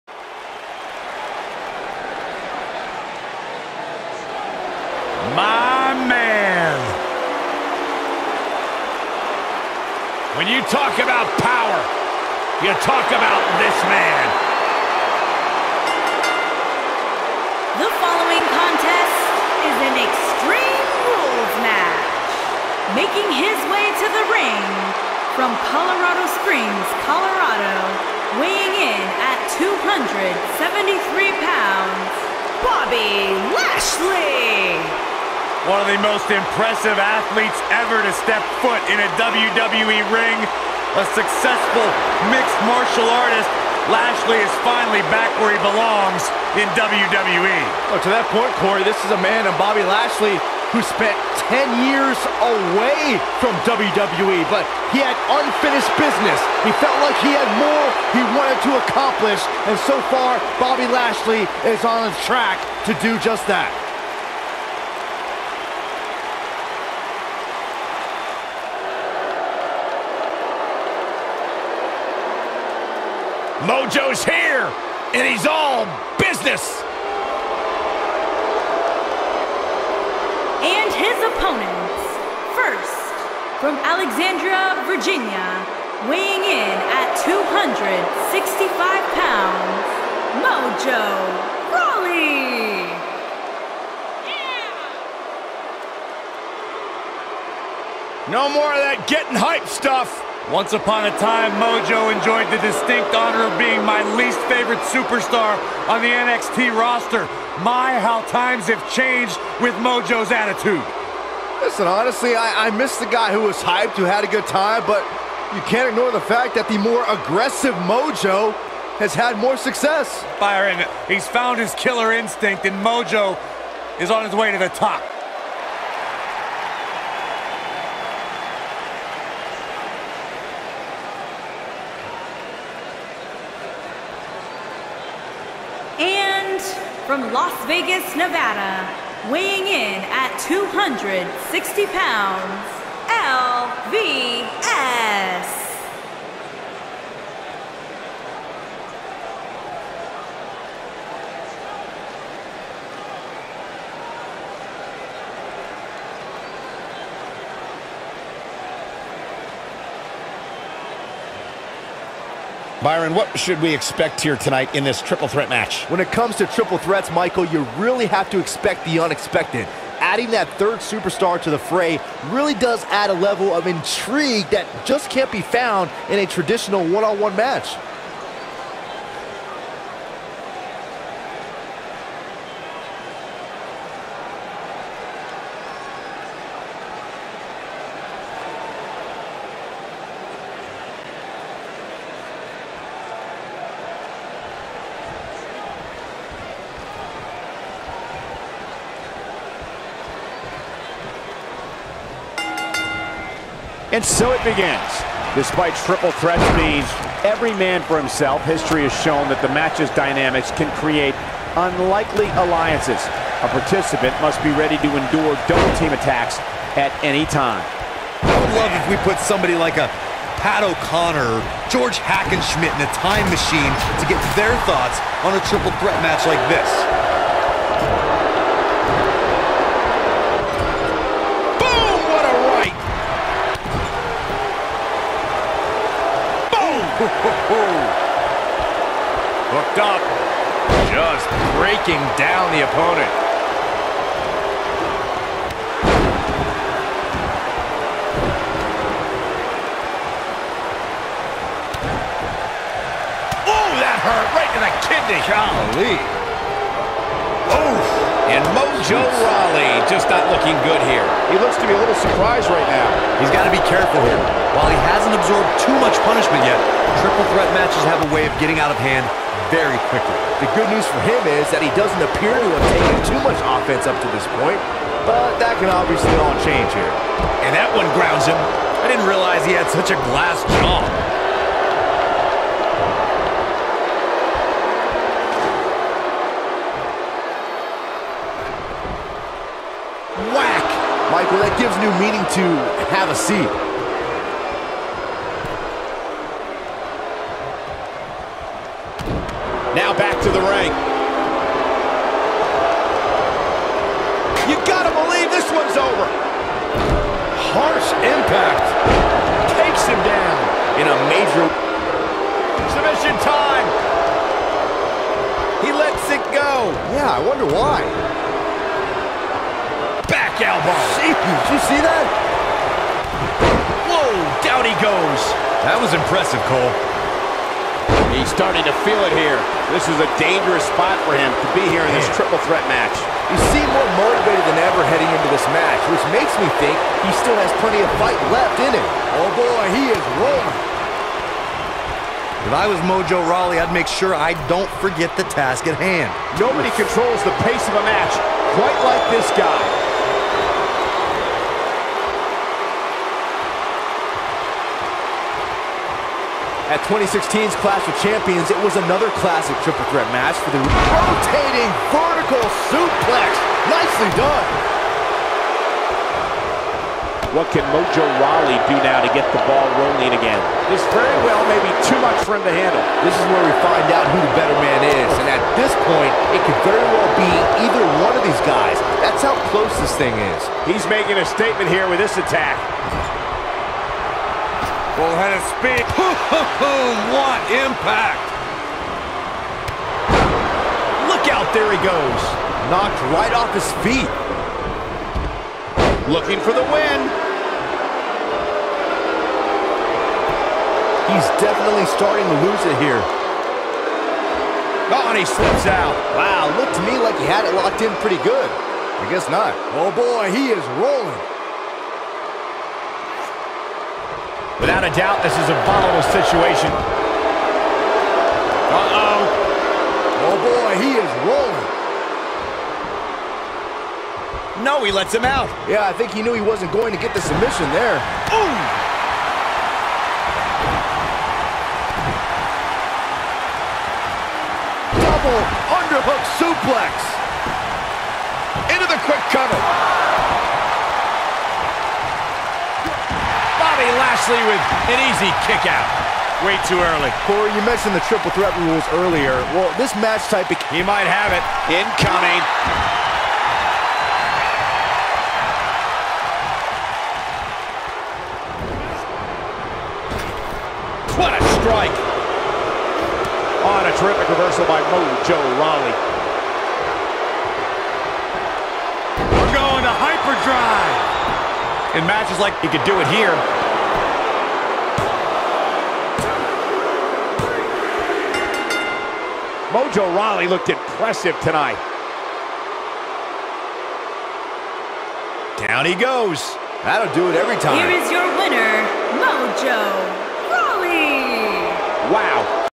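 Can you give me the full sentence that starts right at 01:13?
Mojo's here, and he's all business.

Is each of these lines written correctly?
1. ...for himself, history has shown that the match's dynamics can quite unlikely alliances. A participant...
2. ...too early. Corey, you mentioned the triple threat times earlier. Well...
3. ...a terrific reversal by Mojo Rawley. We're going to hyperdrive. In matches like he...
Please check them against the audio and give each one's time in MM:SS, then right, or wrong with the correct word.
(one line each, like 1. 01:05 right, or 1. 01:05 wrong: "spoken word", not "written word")
1. 03:27 wrong: "create", not "quite"
2. 07:26 wrong: "rules", not "times"
3. 07:43 right.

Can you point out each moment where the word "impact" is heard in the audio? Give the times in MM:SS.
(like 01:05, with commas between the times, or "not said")
05:08, 06:27.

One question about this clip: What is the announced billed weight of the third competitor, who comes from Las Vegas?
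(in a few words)
260 pounds.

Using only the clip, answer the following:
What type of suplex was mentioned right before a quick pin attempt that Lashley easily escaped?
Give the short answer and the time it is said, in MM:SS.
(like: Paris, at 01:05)
Underhook suplex, at 07:15.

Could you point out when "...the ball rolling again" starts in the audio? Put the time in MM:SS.
06:09.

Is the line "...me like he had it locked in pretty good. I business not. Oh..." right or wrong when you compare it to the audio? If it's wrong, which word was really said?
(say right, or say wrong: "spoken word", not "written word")
wrong: "guess", not "business".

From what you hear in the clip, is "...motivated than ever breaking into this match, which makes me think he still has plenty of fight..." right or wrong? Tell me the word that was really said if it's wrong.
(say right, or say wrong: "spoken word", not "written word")
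wrong: "heading", not "breaking".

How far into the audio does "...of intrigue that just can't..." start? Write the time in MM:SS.
02:53.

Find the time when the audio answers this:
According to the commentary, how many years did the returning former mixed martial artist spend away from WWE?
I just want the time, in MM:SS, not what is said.
00:51.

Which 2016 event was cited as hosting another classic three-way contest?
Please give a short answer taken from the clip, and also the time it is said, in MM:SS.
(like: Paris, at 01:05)
Clash of Champions, at 05:57.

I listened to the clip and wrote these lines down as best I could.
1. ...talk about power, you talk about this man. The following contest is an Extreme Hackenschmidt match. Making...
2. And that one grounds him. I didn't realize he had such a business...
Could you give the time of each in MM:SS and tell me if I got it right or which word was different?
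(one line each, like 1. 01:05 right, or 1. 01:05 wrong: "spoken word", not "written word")
1. 00:10 wrong: "Rules", not "Hackenschmidt"
2. 04:37 wrong: "glass", not "business".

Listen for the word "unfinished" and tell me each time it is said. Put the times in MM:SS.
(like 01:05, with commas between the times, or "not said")
00:55.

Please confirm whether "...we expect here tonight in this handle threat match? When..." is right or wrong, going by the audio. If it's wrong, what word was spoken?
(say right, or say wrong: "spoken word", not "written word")
wrong: "triple", not "handle".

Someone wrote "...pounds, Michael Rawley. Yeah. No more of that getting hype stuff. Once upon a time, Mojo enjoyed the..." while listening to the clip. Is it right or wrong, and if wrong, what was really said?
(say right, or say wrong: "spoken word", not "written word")
wrong: "Mojo", not "Michael".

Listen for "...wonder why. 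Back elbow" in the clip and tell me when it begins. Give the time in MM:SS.
05:17.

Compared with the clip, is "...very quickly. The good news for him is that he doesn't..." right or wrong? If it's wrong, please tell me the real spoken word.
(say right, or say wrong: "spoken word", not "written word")
right.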